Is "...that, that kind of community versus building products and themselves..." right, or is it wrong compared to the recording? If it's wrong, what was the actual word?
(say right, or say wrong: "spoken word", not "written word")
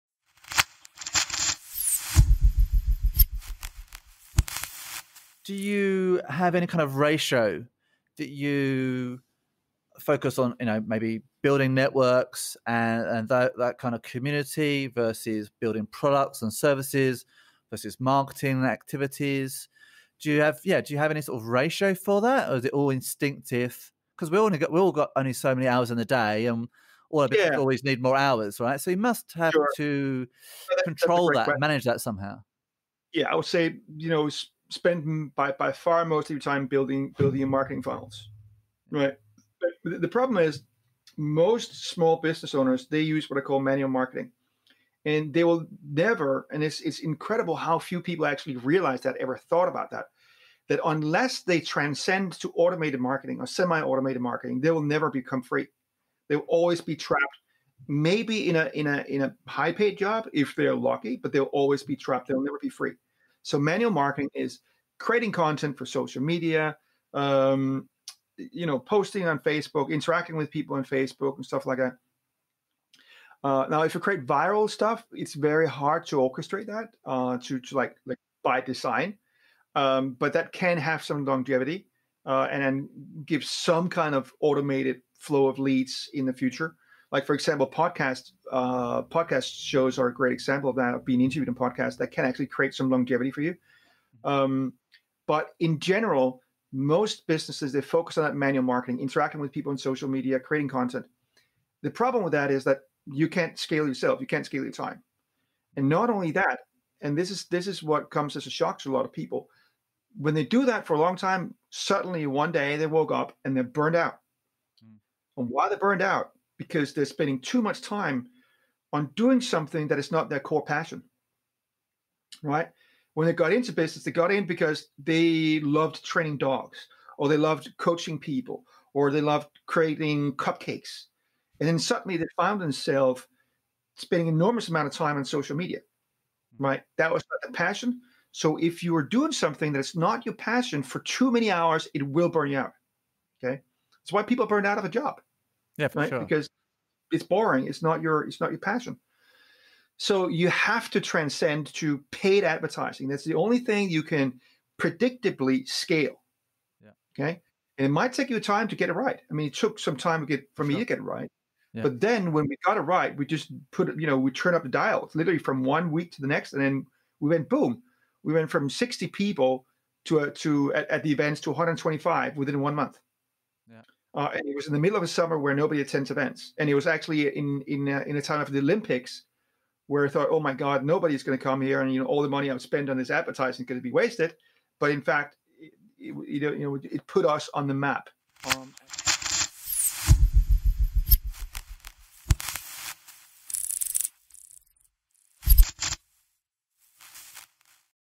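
wrong: "services", not "themselves".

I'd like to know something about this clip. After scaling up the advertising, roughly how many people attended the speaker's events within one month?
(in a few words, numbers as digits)
125.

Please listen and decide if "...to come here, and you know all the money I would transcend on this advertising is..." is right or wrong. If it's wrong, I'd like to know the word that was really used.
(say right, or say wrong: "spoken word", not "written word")
wrong: "spend", not "transcend".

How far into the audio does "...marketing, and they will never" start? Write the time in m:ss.
0:43.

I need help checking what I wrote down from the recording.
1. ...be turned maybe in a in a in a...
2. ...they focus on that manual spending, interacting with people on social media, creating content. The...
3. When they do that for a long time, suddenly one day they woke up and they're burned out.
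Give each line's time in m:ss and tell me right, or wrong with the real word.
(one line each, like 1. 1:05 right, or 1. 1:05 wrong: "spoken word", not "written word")
1. 0:56 wrong: "trapped", not "turned"
2. 1:37 wrong: "marketing", not "spending"
3. 1:50 right.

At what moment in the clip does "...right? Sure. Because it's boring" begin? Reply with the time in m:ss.
2:25.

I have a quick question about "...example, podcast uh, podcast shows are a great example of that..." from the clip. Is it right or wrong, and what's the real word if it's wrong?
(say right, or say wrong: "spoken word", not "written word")
right.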